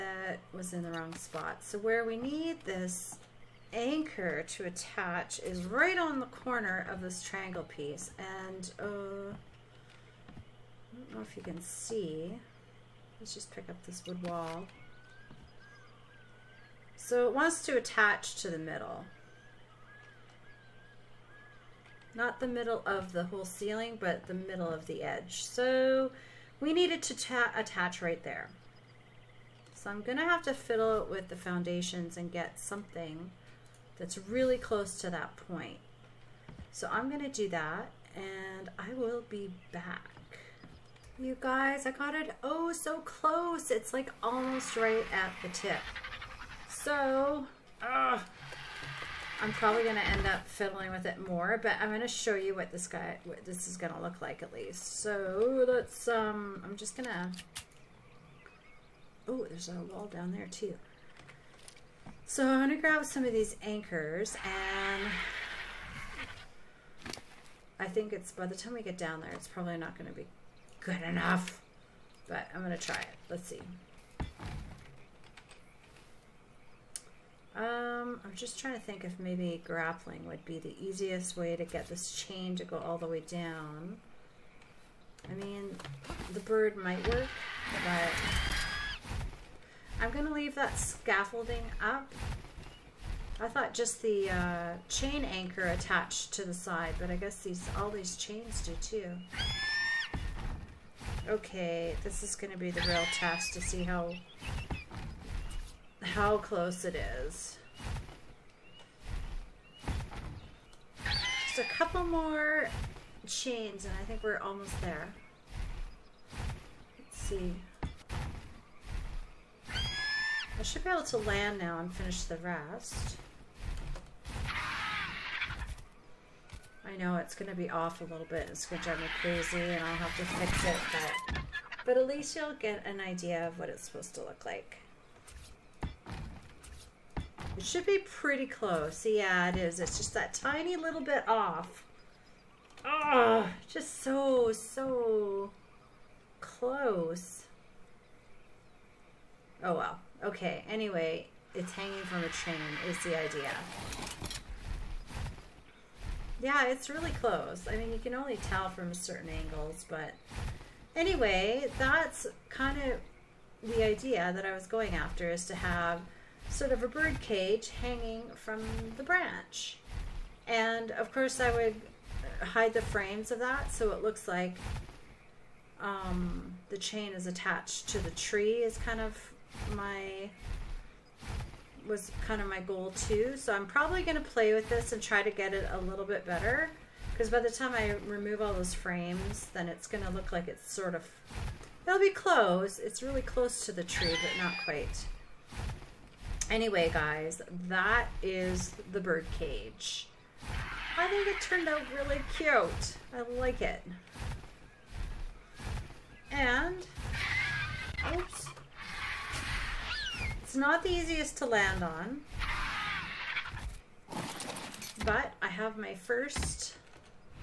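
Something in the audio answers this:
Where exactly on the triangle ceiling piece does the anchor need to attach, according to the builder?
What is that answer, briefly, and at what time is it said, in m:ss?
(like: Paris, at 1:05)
Middle of the edge, at 0:24.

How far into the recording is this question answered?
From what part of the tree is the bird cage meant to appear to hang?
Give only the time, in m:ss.
2:48.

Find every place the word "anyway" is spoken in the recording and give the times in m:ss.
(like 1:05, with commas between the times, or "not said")
2:30, 2:40, 3:16.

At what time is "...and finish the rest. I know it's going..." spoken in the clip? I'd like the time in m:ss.
2:01.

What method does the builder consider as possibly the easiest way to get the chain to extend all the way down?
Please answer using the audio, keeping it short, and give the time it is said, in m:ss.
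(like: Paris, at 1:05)
Grappling, at 1:19.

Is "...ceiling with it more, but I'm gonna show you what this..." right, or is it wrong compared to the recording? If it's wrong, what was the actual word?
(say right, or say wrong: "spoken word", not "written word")
wrong: "fiddling", not "ceiling".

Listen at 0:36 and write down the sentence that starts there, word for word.
So I'm gonna do that and I will be back.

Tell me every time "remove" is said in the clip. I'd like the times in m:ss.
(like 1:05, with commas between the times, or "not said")
3:08.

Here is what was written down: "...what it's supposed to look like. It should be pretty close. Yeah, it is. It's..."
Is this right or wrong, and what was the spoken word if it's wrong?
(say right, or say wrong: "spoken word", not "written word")
right.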